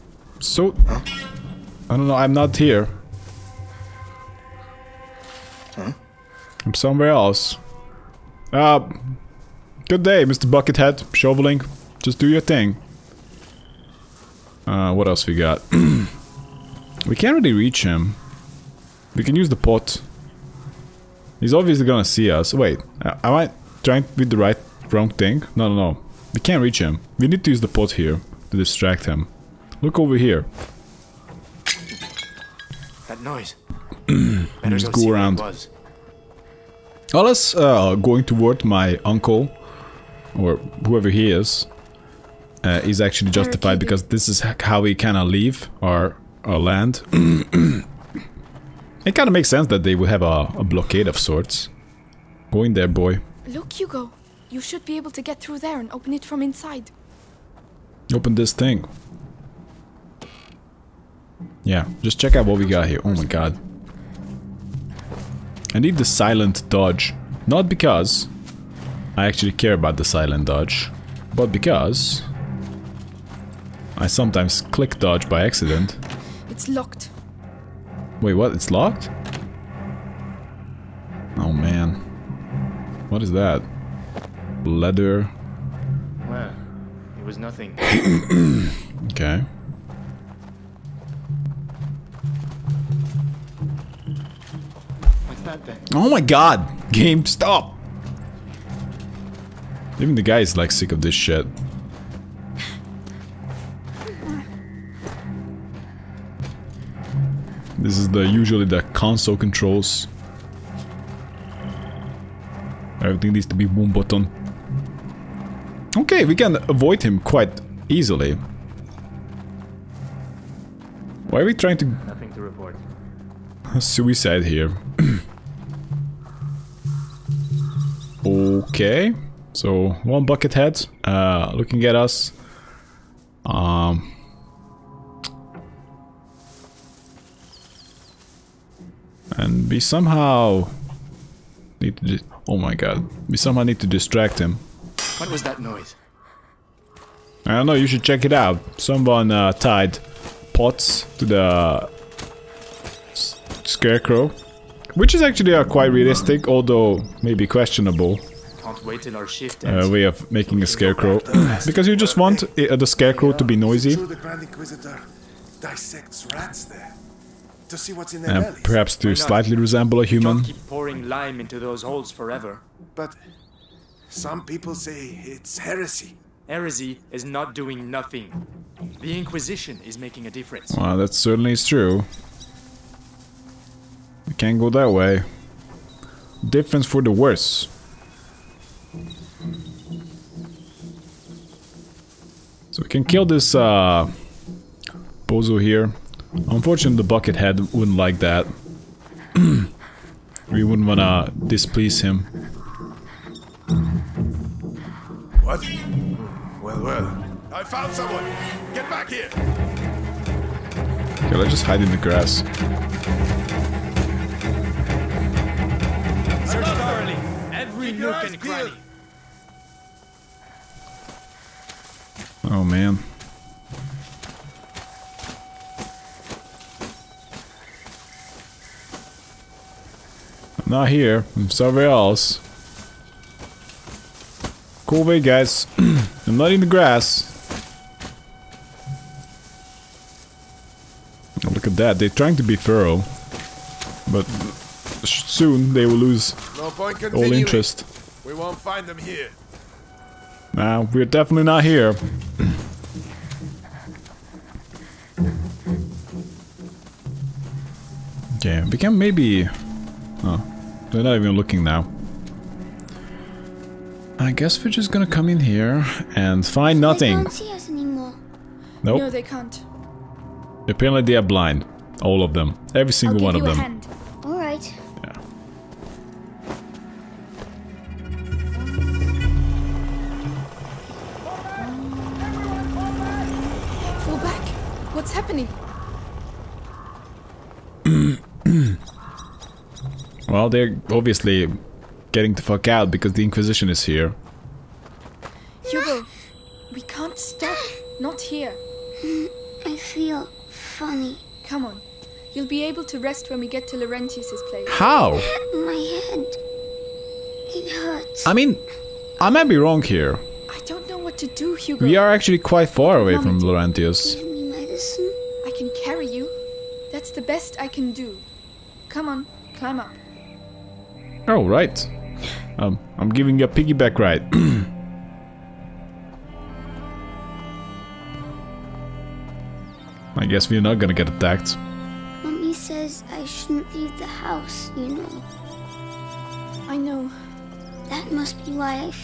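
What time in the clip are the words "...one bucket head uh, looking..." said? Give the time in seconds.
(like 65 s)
130 s.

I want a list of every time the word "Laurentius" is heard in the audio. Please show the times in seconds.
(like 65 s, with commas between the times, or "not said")
303 s, 313 s.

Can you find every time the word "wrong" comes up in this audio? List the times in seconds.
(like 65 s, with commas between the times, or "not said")
24 s, 309 s.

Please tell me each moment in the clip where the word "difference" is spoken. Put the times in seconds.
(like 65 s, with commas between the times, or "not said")
180 s, 186 s.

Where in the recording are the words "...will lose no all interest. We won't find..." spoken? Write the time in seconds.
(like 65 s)
245 s.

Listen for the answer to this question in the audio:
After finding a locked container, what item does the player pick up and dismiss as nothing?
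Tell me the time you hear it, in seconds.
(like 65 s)
84 s.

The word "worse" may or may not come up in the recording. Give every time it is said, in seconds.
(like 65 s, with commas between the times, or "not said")
187 s.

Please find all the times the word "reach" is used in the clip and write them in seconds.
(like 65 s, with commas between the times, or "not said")
17 s, 26 s.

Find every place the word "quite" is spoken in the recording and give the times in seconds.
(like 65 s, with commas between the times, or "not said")
117 s, 155 s, 312 s.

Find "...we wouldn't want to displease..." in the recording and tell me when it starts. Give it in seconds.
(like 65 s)
199 s.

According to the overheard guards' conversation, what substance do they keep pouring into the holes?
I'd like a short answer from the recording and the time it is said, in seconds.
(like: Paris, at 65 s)
lime, at 171 s.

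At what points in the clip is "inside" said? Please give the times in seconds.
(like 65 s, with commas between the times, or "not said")
56 s.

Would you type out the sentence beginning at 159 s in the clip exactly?
Uh, way of making a scarecrow.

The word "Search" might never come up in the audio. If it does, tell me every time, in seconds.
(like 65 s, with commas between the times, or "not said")
216 s.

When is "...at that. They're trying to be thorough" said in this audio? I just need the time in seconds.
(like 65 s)
241 s.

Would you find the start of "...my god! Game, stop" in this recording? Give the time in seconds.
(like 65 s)
96 s.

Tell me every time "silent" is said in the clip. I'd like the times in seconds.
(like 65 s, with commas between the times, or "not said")
66 s, 70 s.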